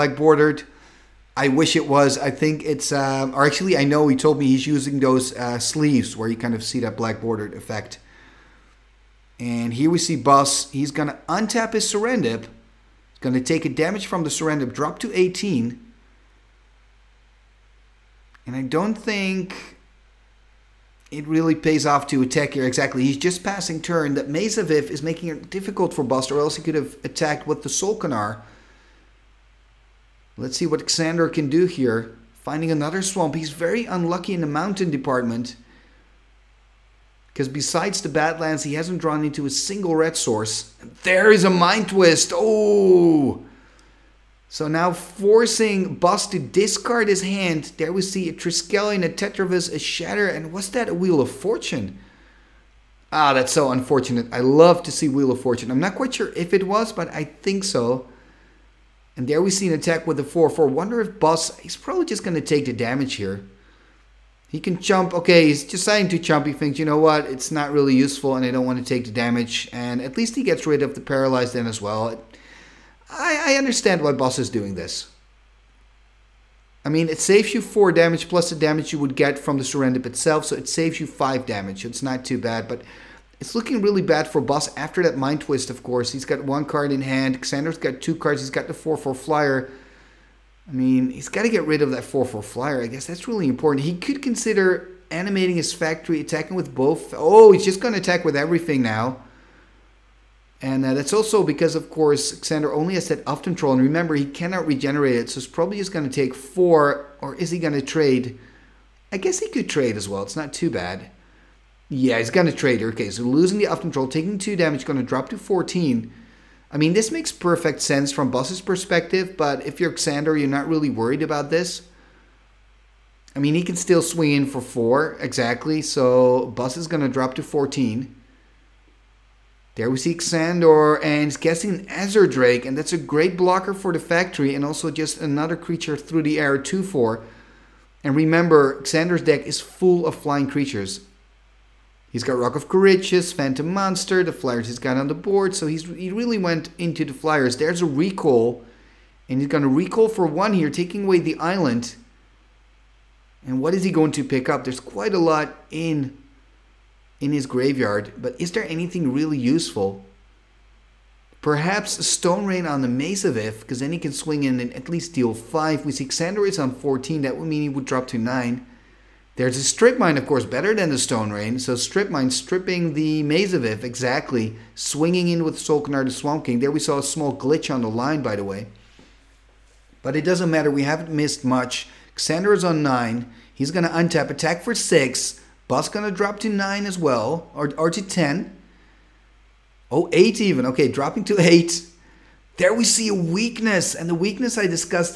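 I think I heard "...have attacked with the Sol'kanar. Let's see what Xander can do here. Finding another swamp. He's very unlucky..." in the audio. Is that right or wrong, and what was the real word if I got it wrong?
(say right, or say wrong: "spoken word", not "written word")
right.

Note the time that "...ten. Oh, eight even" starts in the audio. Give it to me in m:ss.
3:08.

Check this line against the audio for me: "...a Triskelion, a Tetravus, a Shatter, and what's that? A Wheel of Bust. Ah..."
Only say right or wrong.
wrong.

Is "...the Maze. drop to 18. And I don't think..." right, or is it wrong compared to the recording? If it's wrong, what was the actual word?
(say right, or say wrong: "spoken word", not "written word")
wrong: "Serendib", not "Maze".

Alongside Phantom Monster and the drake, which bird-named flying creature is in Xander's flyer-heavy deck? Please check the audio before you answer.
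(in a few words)
Roc of Kher Ridges.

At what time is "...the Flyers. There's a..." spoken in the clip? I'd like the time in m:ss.
2:27.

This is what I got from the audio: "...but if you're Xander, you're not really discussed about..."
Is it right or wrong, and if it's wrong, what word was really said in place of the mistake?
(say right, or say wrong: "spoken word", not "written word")
wrong: "worried", not "discussed".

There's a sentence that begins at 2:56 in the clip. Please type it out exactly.
There we saw a small glitch on the line, by the way.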